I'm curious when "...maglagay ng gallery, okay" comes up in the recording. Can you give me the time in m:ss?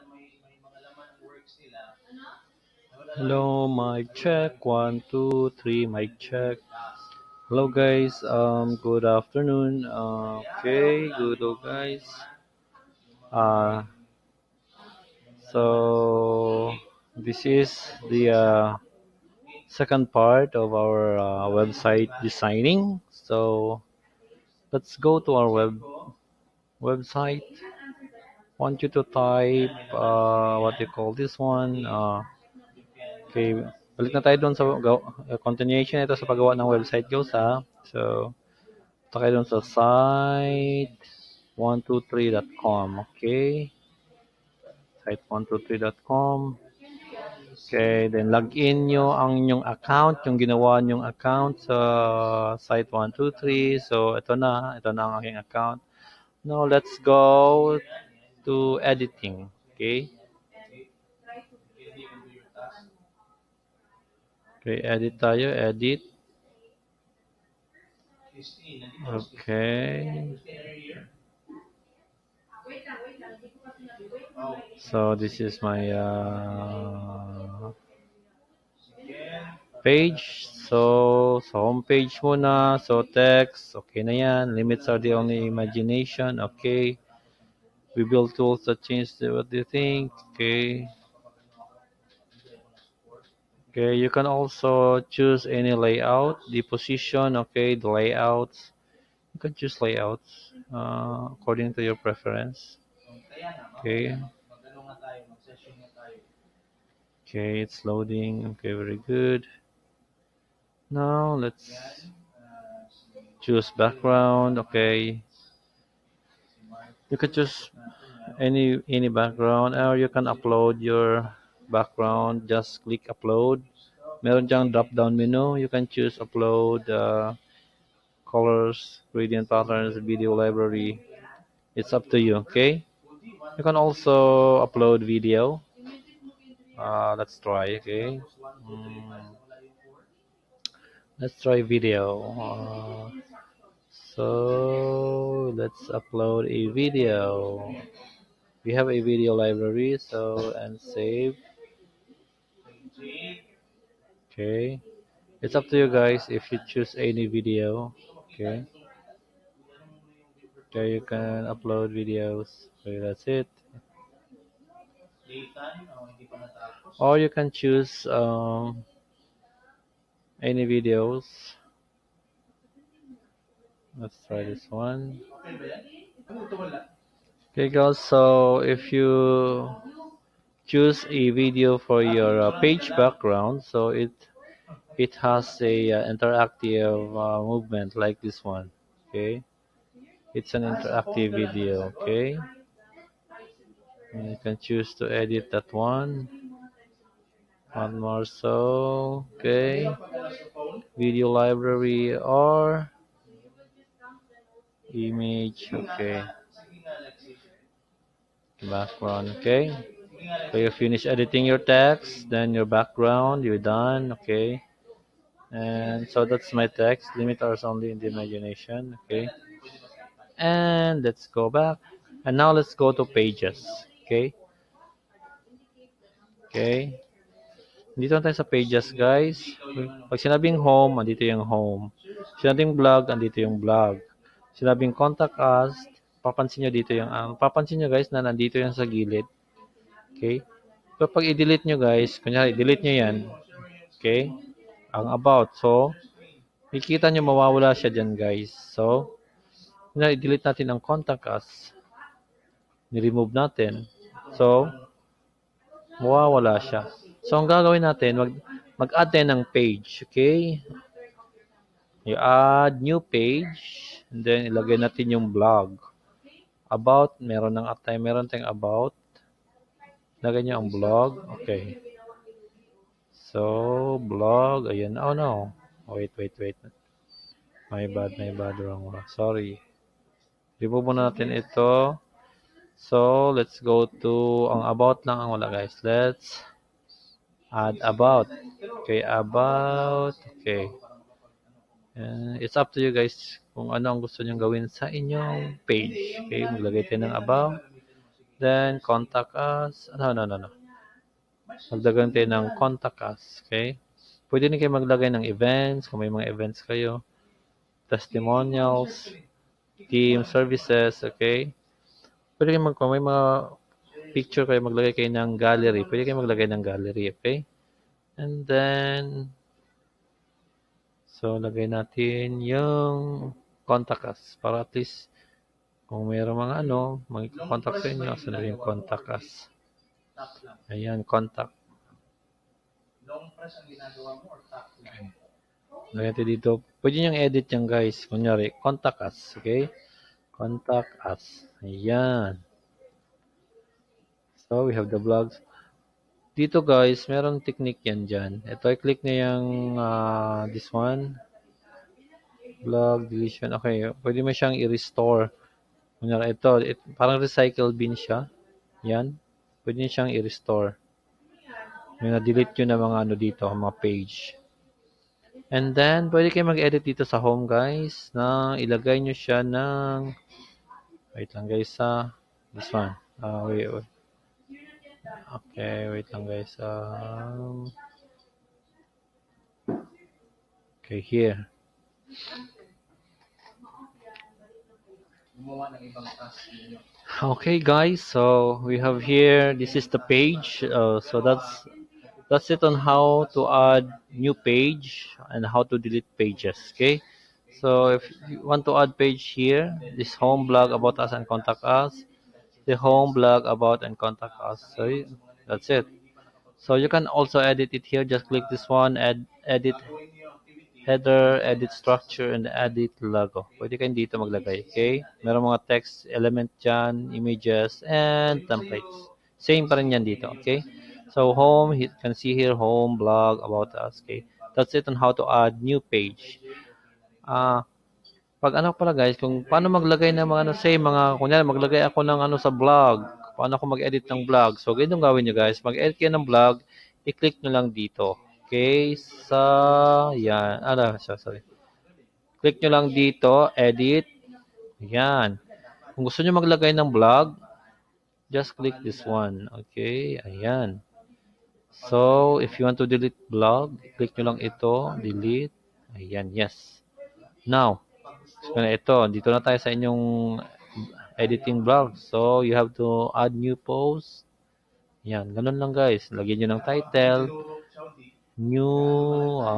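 5:16.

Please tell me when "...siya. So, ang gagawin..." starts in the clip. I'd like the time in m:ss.
4:16.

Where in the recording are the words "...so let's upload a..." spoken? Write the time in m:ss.
2:23.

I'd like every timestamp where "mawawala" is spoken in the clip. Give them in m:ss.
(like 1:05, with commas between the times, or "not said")
4:07, 4:16.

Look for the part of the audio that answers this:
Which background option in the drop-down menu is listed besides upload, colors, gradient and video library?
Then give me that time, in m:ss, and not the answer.
2:09.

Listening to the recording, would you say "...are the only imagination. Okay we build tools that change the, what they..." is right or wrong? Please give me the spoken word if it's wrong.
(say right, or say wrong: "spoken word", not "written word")
right.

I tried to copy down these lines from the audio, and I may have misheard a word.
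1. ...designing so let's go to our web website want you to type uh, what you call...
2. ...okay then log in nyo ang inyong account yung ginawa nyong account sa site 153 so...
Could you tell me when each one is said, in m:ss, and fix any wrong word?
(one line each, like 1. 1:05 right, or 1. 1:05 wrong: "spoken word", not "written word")
1. 0:22 right
2. 0:47 wrong: "123", not "153".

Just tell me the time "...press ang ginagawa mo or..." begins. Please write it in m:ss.
5:33.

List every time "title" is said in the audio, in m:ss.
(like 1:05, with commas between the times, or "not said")
7:46.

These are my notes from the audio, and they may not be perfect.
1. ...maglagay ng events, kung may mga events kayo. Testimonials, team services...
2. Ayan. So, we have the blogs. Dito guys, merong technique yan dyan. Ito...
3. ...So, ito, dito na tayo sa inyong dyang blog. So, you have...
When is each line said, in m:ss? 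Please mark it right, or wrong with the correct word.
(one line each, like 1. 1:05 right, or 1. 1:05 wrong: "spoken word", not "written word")
1. 5:04 right
2. 5:41 right
3. 7:38 wrong: "editing", not "dyang".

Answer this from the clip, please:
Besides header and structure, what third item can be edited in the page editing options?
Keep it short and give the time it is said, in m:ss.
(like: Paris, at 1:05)
logo, at 6:52.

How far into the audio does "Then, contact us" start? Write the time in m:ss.
4:58.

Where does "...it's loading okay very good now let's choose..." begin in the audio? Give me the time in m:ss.
1:47.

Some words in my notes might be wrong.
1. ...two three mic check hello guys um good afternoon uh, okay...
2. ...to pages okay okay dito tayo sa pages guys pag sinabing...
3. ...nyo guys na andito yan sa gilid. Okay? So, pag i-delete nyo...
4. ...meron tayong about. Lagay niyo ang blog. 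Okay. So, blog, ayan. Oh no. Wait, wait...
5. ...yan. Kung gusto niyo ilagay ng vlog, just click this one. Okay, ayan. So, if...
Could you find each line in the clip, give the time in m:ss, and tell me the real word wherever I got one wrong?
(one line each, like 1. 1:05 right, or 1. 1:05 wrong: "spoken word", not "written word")
1. 0:05 right
2. 3:42 right
3. 3:57 wrong: "nandito", not "andito"
4. 4:28 right
5. 7:24 wrong: "maglagay", not "ilagay".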